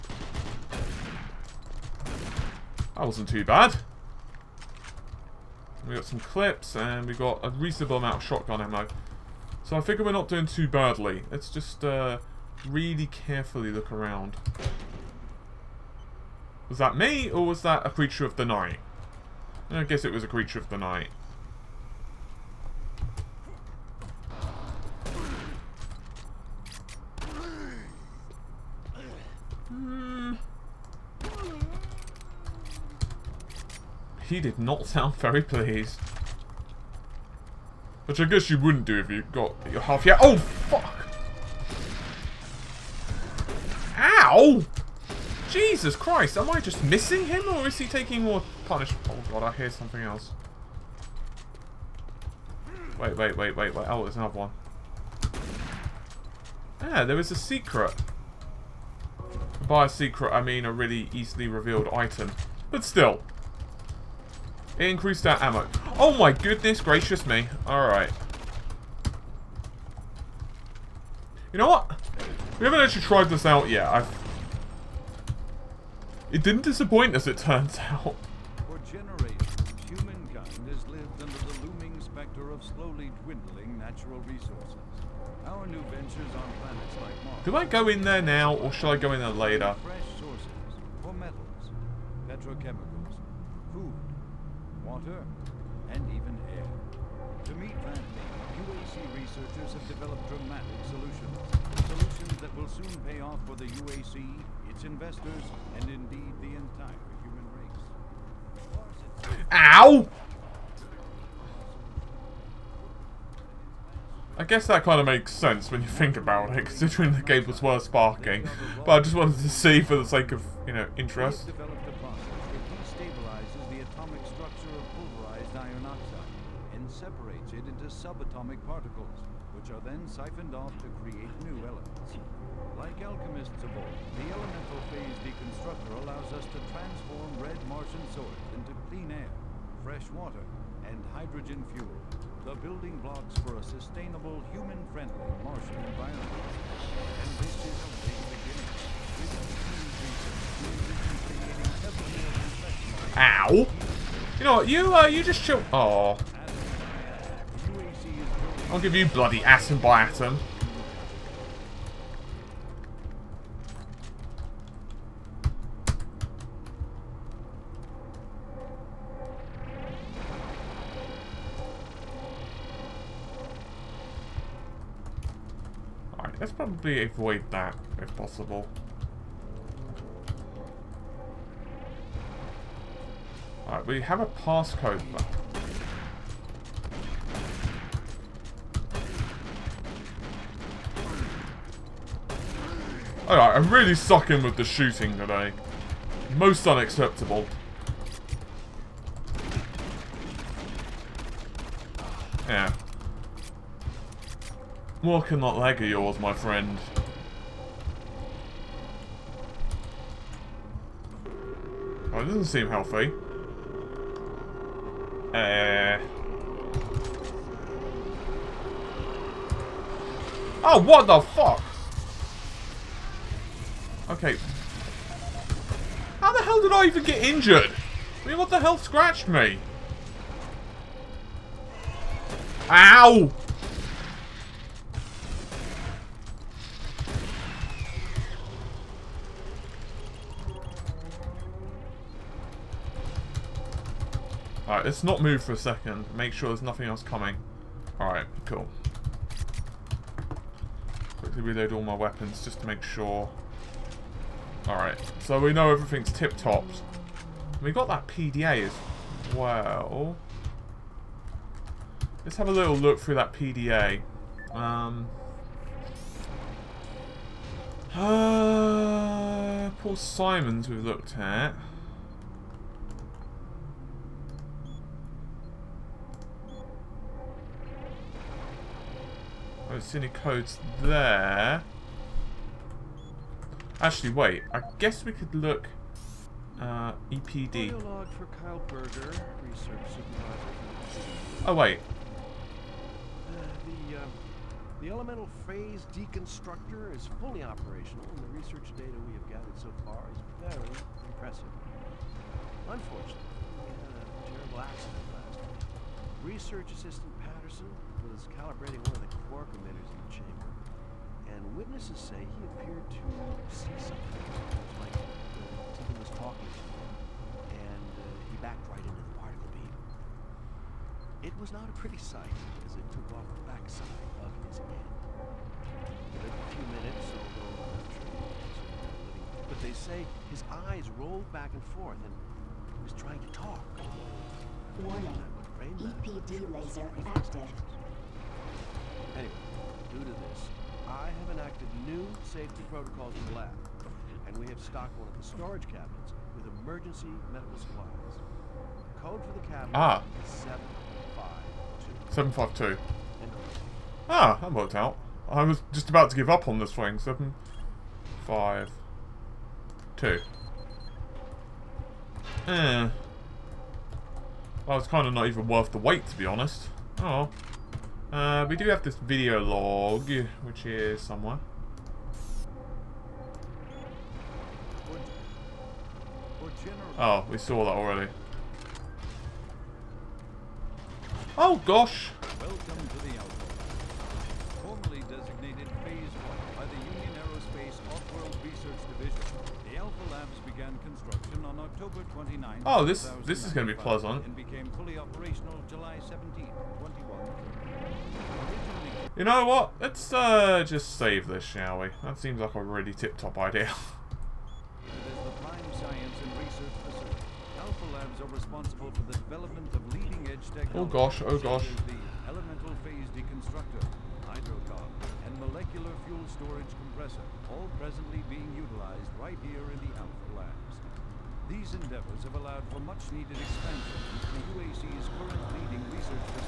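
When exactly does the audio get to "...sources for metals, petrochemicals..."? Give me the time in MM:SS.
01:30.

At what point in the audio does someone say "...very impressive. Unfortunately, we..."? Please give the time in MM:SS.
05:00.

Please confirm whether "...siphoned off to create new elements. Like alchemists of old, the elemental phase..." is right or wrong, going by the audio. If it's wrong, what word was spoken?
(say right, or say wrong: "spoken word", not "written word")
right.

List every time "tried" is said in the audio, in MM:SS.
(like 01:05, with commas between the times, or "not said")
01:13.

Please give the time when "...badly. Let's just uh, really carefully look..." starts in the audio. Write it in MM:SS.
00:10.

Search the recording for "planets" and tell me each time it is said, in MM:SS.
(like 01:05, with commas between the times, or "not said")
01:26.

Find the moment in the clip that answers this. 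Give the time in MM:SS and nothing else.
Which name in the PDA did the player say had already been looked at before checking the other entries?
04:29.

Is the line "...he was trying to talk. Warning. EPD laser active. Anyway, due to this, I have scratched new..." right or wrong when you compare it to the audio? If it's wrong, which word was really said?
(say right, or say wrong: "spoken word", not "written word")
wrong: "enacted", not "scratched".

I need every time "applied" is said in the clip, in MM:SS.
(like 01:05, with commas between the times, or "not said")
not said.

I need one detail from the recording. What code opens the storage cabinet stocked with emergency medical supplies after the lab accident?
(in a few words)
752.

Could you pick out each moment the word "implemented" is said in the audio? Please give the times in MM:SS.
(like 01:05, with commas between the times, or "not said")
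not said.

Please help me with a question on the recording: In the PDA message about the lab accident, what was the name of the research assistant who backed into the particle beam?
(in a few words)
Patterson.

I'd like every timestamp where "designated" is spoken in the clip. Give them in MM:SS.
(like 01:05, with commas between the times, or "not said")
06:25.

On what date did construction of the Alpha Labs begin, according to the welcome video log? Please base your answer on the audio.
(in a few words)
October 29th.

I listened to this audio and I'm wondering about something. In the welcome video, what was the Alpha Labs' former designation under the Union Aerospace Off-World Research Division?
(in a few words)
Phase 1.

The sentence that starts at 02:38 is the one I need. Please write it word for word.
I'll give you bloody atom by atom.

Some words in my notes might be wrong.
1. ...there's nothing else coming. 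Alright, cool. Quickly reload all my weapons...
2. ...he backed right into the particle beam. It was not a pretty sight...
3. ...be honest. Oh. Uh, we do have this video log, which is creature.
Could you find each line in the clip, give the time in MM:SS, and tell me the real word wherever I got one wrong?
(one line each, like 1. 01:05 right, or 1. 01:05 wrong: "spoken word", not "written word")
1. 04:06 right
2. 05:18 right
3. 06:06 wrong: "somewhere", not "creature".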